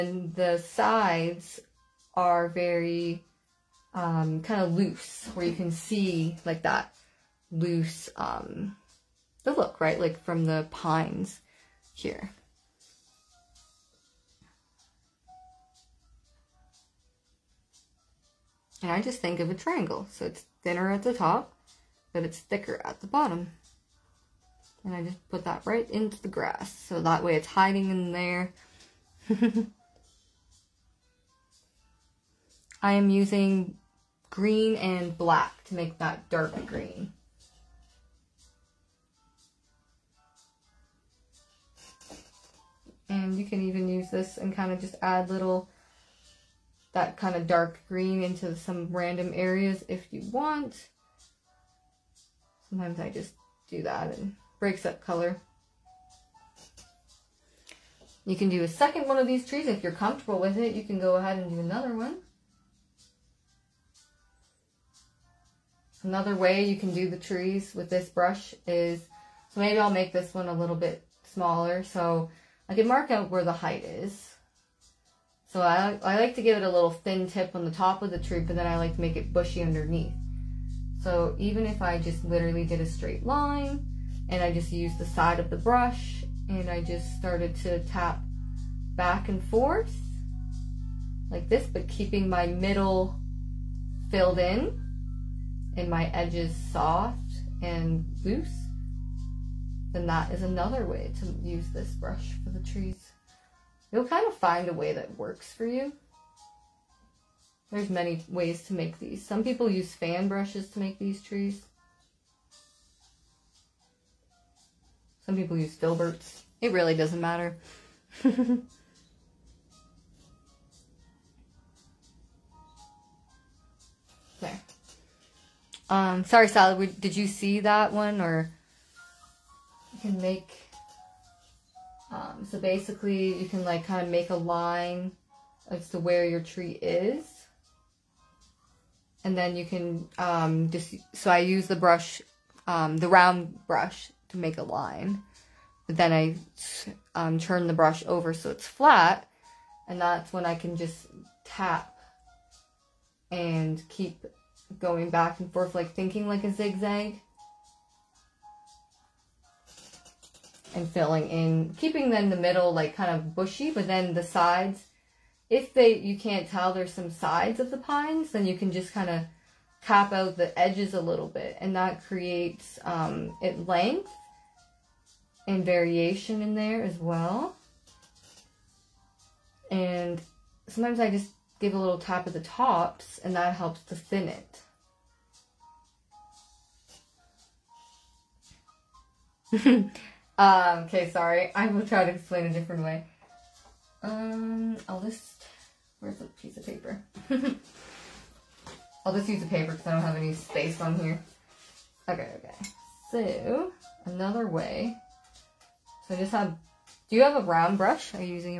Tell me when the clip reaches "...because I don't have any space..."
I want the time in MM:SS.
03:19.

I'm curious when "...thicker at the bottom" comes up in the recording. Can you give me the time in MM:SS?
00:22.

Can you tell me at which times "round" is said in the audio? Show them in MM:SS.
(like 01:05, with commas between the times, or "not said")
02:23, 03:27.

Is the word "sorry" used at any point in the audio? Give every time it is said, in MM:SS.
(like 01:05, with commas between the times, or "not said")
02:06, 03:11.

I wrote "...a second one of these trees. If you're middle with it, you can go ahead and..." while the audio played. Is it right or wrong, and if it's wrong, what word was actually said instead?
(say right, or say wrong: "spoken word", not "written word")
wrong: "comfortable", not "middle".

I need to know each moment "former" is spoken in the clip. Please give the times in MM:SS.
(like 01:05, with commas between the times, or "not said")
not said.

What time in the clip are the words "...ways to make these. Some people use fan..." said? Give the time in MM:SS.
01:48.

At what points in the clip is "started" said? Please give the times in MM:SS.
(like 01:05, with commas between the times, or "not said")
01:27.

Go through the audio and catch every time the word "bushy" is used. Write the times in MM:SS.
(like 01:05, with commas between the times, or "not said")
01:19, 02:43.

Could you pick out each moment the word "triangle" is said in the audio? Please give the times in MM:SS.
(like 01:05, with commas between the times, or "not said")
00:19.